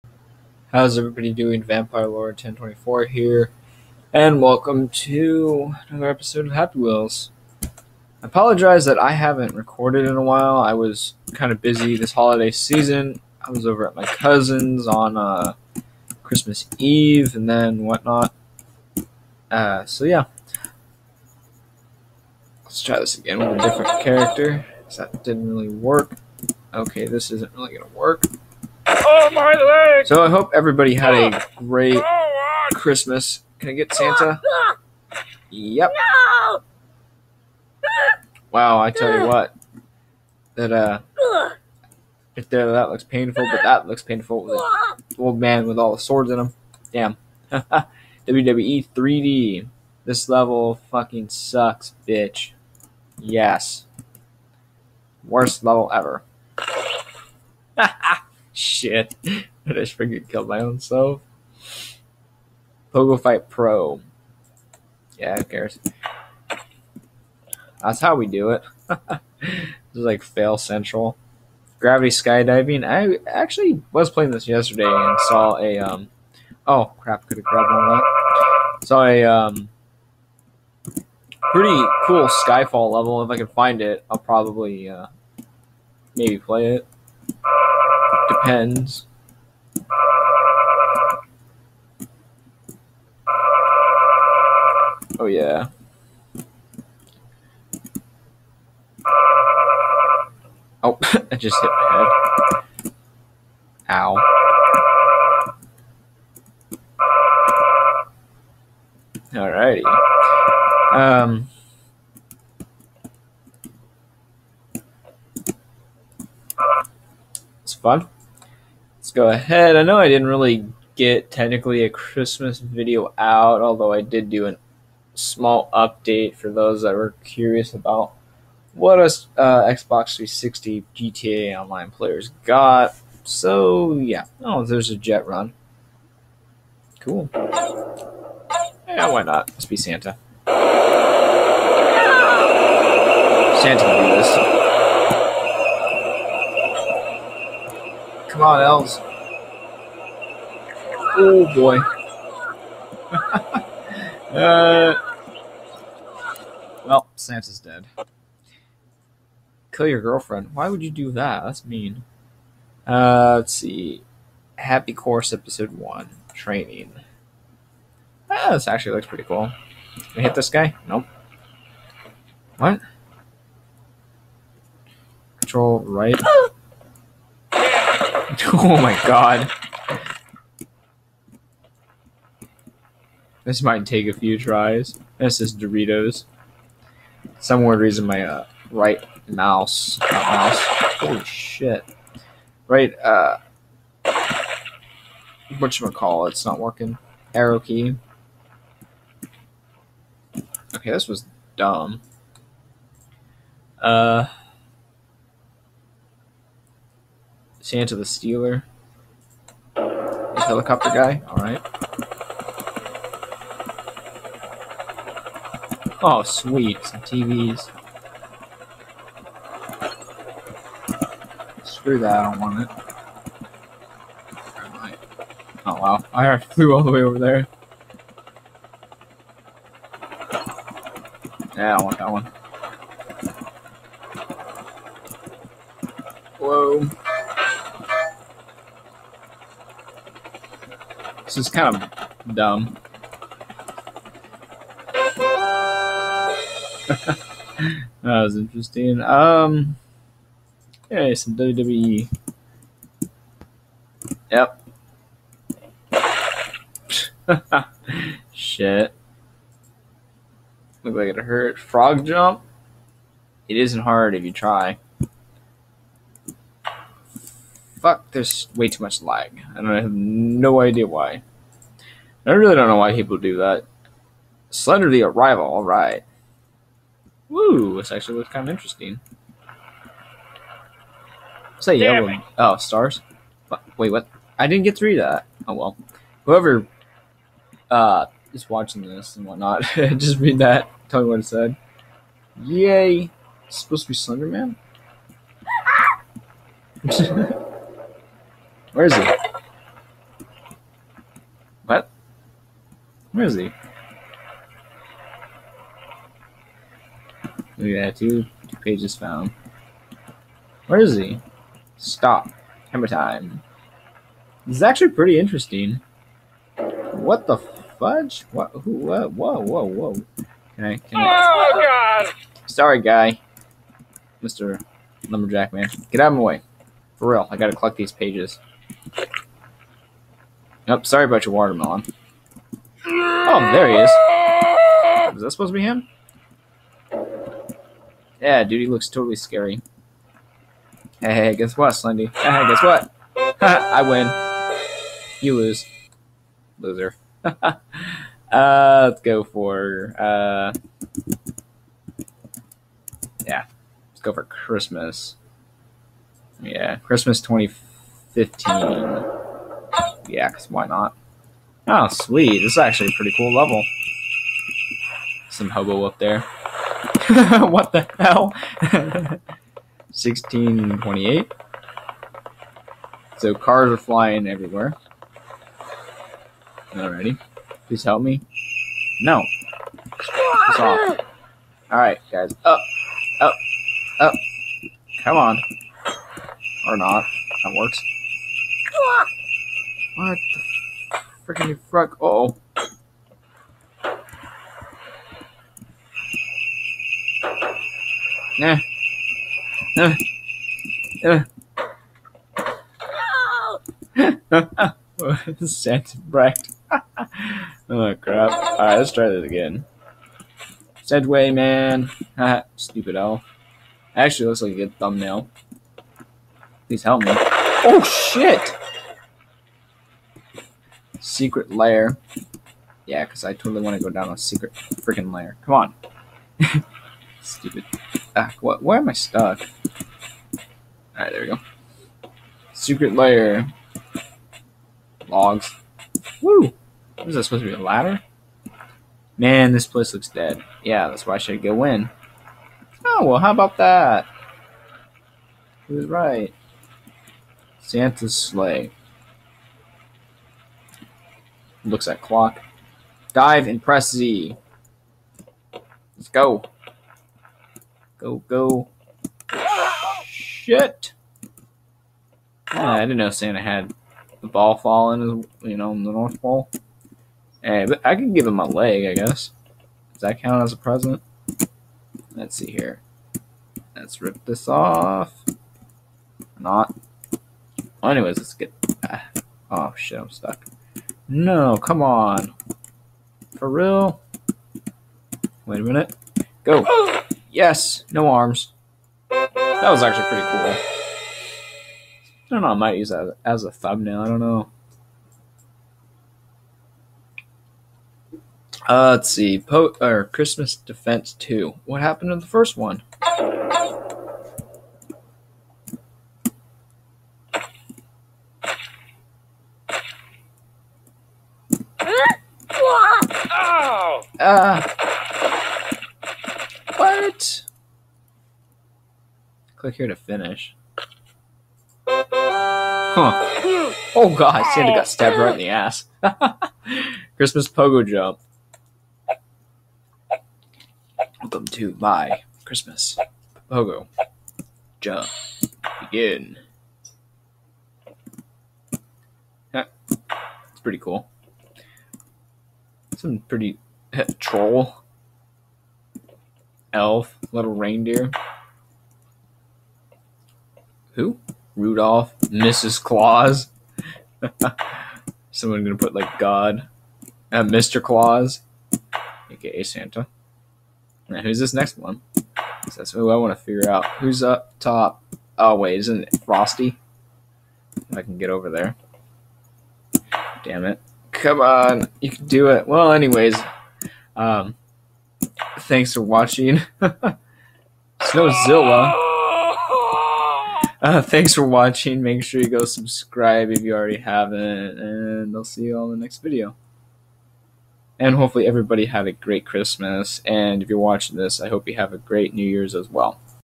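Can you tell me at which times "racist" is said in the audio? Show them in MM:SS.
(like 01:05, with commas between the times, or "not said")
not said.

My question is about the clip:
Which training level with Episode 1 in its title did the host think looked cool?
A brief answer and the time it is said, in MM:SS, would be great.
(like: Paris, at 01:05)
Happy Course Episode 1 Training, at 02:44.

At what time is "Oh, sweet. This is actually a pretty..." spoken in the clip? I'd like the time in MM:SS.
06:01.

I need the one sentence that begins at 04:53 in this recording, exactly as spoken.
It's supposed to be Slender Man?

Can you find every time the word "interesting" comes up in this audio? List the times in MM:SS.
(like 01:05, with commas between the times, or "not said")
04:08, 04:38, 05:15.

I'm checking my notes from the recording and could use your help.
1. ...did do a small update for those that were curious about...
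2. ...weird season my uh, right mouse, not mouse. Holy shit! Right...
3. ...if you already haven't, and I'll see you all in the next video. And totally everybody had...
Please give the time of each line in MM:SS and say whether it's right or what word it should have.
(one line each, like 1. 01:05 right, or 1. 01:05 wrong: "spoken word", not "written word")
1. 02:04 right
2. 03:07 wrong: "reason", not "season"
3. 09:43 wrong: "hopefully", not "totally".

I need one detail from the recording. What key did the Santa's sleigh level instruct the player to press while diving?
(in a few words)
Z.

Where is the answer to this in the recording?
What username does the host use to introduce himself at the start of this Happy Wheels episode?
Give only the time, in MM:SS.
00:01.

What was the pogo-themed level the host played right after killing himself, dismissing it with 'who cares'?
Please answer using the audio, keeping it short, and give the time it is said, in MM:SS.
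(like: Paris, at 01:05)
Pogo Fight Pro, at 01:02.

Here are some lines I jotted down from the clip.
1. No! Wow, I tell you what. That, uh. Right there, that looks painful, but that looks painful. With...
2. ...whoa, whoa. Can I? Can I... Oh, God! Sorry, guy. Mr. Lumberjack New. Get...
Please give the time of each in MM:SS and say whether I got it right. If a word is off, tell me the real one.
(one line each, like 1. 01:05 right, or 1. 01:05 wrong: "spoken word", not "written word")
1. 00:35 right
2. 05:19 wrong: "Man", not "New".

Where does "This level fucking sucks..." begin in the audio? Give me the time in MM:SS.
00:50.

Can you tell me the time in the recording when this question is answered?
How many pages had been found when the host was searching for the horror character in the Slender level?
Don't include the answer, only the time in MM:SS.
05:08.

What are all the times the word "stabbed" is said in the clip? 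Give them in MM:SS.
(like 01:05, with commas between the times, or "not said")
08:44.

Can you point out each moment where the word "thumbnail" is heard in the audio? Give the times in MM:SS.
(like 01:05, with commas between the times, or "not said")
06:54, 08:13.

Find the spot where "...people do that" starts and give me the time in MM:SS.
04:32.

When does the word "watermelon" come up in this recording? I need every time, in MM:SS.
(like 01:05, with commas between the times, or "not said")
05:31.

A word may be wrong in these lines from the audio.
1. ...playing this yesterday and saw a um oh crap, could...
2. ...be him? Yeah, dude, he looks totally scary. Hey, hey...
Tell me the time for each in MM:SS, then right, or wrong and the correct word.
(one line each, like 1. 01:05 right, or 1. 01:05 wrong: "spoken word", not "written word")
1. 01:14 right
2. 05:35 right.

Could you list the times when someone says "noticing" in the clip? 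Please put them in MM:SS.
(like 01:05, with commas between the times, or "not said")
not said.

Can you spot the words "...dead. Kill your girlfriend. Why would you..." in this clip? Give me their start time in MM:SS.
02:37.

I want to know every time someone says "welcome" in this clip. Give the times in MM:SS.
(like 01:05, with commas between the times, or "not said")
00:04, 08:51.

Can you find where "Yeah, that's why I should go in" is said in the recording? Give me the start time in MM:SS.
07:20.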